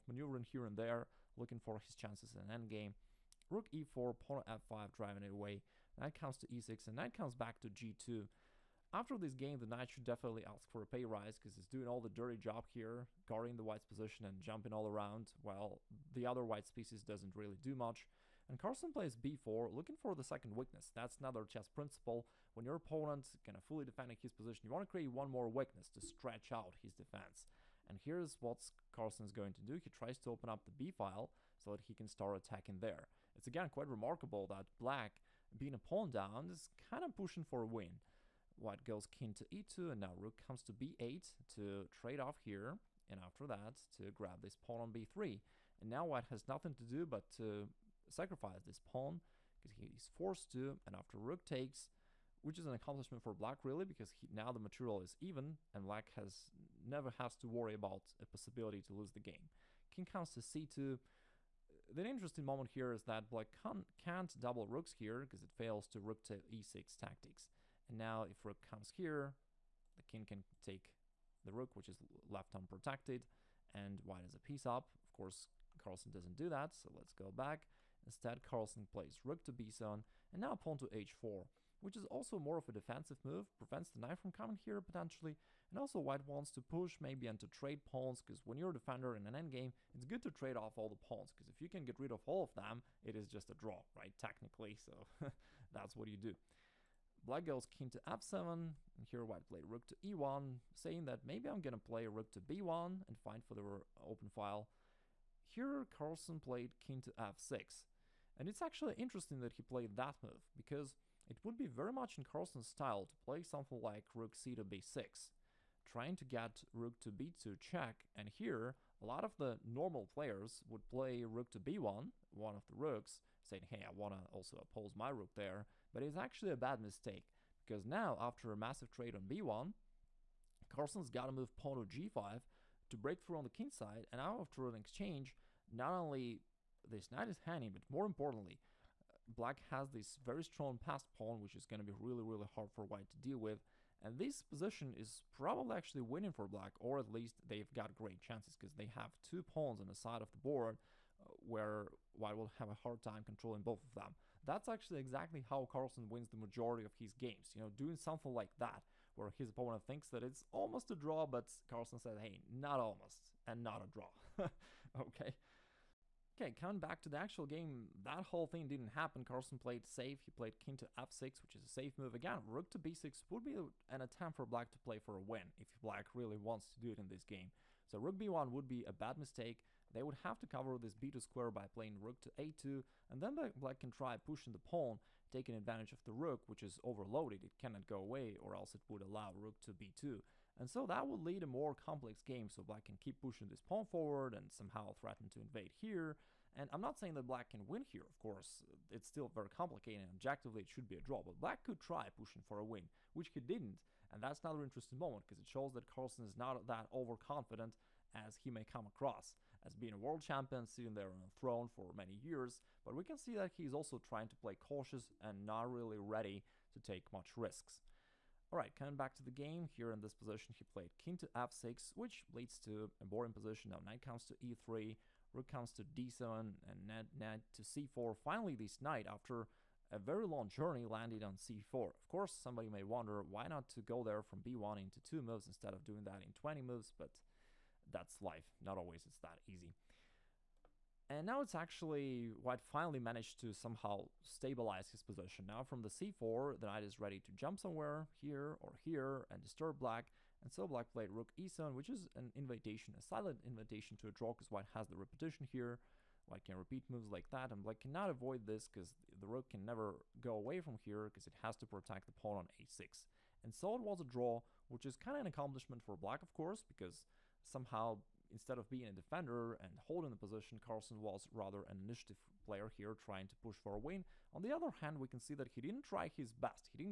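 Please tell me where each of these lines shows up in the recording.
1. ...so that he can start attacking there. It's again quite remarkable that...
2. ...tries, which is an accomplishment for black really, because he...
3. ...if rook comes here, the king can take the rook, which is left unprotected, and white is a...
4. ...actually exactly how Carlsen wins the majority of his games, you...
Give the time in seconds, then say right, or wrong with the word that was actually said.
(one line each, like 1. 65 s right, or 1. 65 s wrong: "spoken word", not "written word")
1. 31 s right
2. 51 s wrong: "takes", not "tries"
3. 68 s right
4. 154 s right.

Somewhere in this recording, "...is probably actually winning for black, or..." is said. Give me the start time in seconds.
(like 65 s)
144 s.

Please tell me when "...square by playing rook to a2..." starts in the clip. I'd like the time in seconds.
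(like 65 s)
181 s.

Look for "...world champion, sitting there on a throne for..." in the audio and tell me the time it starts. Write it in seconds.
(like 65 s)
209 s.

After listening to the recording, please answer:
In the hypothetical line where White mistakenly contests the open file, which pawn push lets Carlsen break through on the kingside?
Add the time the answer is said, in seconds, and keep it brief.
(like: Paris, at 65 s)
g5, at 131 s.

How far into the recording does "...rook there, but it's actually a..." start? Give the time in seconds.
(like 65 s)
125 s.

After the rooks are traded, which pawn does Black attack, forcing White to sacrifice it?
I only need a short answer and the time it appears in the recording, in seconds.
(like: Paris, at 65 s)
b3, at 44 s.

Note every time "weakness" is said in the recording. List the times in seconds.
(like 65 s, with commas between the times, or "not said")
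20 s, 25 s.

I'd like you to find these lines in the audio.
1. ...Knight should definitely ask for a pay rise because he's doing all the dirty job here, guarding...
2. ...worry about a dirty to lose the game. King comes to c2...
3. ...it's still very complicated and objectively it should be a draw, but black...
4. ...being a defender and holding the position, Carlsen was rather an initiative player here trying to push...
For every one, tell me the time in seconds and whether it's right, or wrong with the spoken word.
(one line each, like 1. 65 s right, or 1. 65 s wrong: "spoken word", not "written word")
1. 9 s right
2. 57 s wrong: "possibility", not "dirty"
3. 198 s right
4. 268 s right.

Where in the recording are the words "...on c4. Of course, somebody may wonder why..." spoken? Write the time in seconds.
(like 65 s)
231 s.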